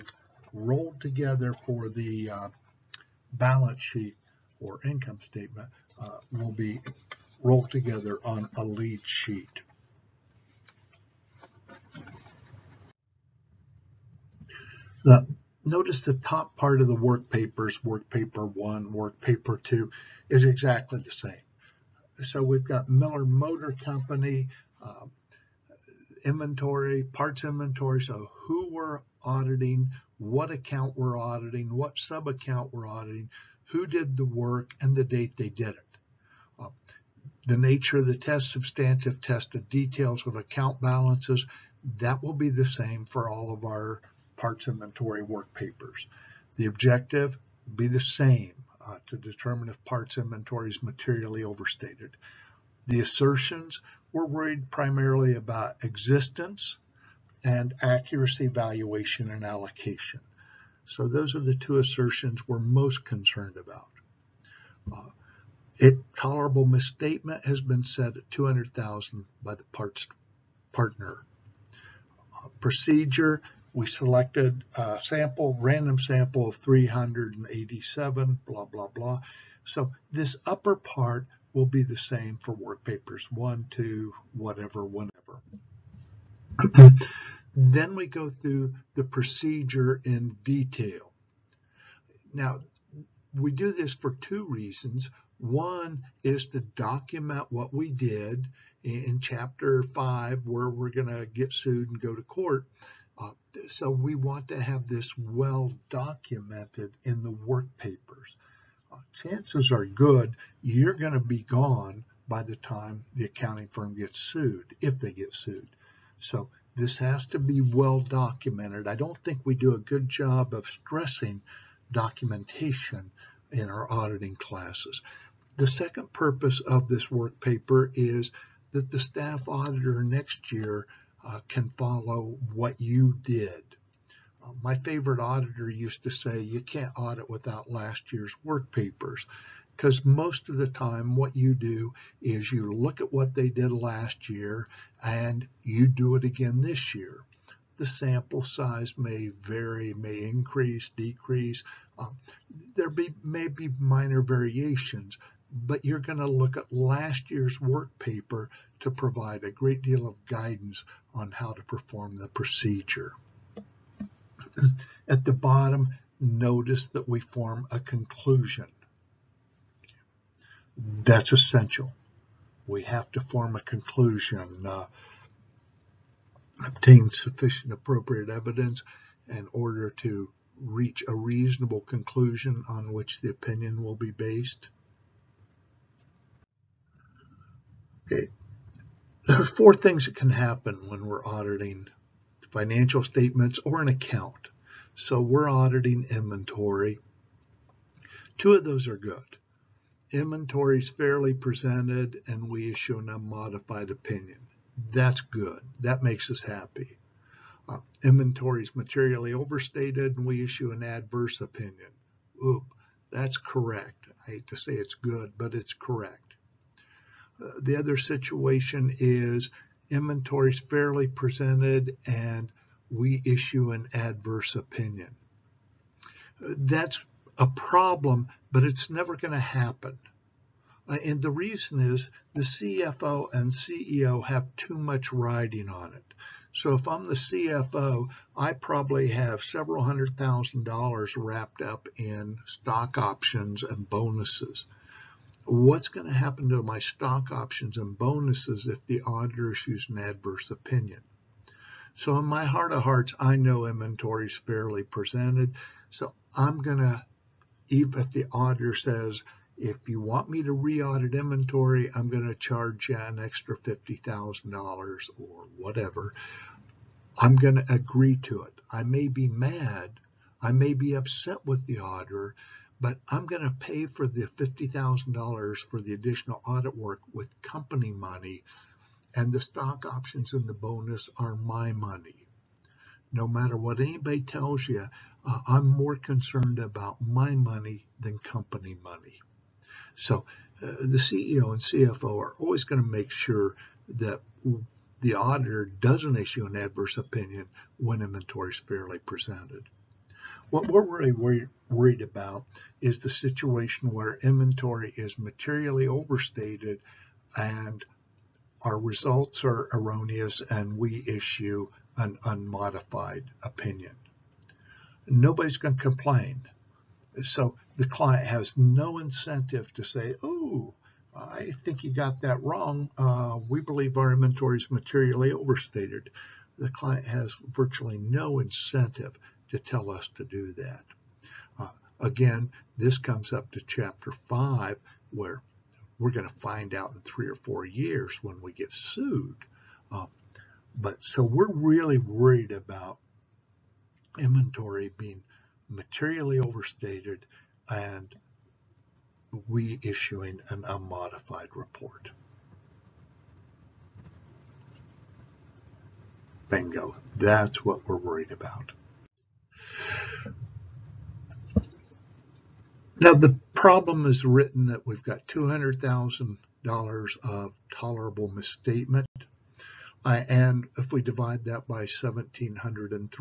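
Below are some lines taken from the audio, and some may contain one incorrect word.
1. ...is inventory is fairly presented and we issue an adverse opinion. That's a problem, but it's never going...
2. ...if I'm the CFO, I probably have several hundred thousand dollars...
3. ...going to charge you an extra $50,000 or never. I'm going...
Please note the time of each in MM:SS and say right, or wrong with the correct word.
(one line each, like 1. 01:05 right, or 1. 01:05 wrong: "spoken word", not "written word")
1. 03:38 right
2. 03:56 right
3. 04:22 wrong: "whatever", not "never".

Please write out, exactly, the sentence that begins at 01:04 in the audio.
Uh, it tolerable misstatement has been set at 200,000 by the parts partner.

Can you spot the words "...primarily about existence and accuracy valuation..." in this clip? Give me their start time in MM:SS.
00:54.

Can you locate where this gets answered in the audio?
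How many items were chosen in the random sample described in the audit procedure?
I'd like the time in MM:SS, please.
01:16.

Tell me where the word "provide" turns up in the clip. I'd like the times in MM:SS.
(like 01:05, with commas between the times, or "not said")
02:38.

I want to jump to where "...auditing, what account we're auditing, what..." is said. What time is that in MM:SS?
00:29.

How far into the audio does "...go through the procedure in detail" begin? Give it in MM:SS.
01:28.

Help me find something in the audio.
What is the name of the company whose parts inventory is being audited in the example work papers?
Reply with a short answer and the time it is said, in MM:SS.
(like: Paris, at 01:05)
Miller Motor Company, at 00:22.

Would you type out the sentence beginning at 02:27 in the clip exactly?
The sample size may vary, may increase, decrease.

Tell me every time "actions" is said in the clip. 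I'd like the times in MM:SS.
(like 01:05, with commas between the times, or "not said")
not said.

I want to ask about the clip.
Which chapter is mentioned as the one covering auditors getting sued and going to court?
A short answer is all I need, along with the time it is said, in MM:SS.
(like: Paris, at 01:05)
Chapter 5, at 01:39.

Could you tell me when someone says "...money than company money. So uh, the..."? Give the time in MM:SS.
04:47.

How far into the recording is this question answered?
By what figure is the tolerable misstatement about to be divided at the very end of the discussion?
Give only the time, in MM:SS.
06:11.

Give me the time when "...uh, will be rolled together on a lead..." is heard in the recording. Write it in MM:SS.
00:06.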